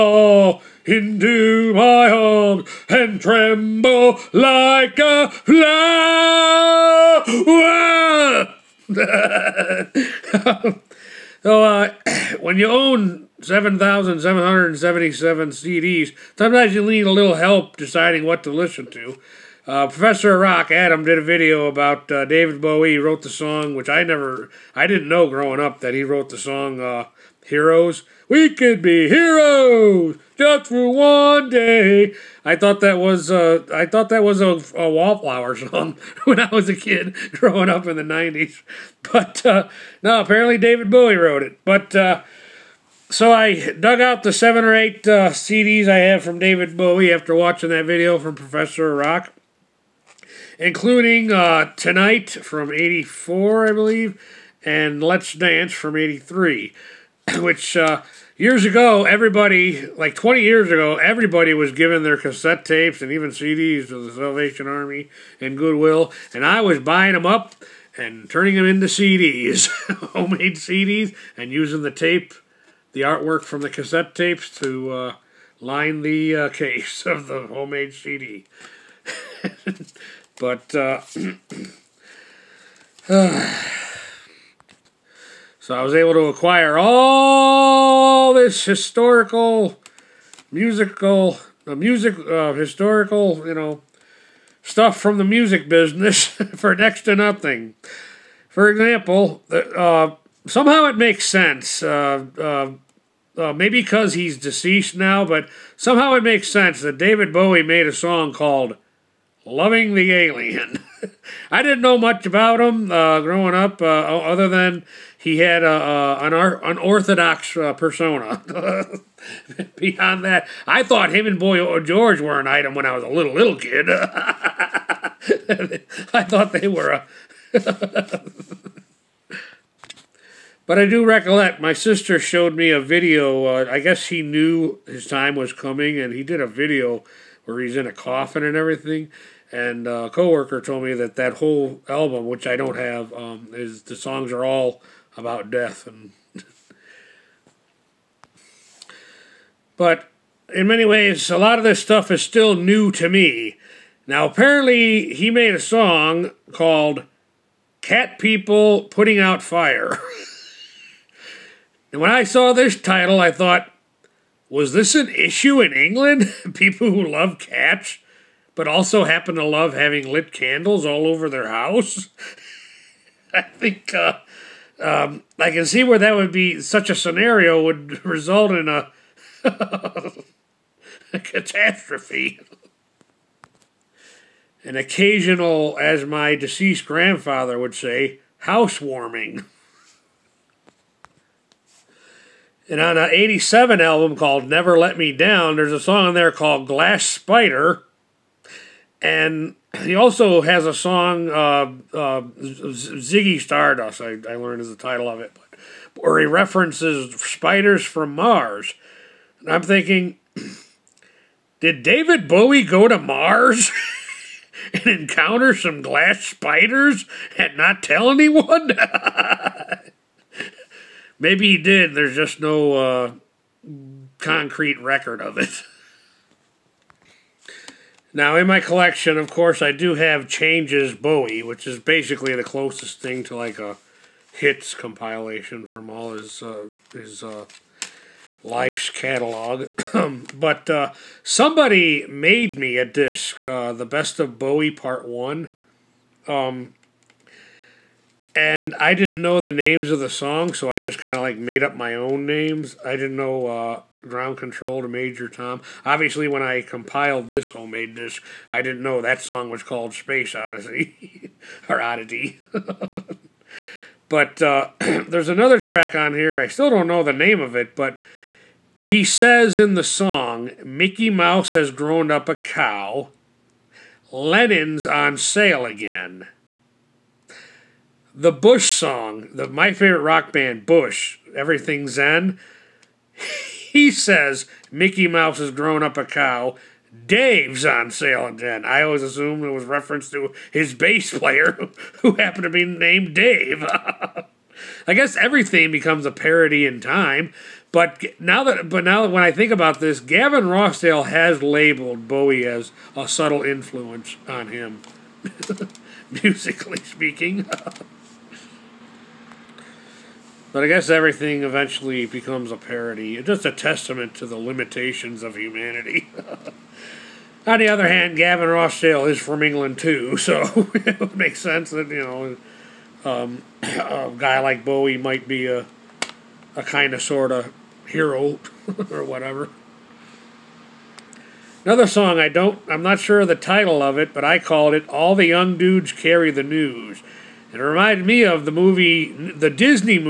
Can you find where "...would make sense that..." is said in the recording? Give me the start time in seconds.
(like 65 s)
320 s.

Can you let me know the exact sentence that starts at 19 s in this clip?
Uh, Professor Rock Adam did a video about uh, David Bowie.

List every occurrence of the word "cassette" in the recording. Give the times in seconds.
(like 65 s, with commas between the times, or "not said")
62 s, 73 s.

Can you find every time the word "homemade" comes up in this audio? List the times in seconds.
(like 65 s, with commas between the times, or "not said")
70 s, 77 s, 257 s.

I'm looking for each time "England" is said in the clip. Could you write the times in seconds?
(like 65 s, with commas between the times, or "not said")
165 s, 319 s.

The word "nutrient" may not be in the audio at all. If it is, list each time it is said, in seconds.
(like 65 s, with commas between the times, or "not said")
not said.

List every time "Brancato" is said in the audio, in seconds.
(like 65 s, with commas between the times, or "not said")
not said.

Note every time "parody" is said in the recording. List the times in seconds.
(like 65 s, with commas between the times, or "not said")
296 s, 312 s.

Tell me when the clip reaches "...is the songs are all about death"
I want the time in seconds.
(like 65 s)
143 s.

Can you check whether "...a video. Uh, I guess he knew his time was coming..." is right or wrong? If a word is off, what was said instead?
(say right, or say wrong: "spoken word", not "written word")
right.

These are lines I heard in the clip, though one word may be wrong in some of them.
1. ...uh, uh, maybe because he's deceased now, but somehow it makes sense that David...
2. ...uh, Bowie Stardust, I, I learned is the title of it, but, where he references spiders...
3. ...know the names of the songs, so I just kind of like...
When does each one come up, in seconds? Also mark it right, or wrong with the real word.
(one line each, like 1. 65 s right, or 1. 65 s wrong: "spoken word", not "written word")
1. 102 s right
2. 201 s wrong: "Ziggy", not "Bowie"
3. 249 s right.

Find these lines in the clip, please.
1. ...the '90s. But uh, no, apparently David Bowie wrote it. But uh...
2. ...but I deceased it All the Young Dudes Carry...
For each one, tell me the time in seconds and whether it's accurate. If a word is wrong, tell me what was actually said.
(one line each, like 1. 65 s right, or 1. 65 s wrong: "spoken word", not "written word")
1. 37 s right
2. 334 s wrong: "called", not "deceased".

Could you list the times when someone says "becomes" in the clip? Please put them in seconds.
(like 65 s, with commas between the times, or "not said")
295 s, 312 s.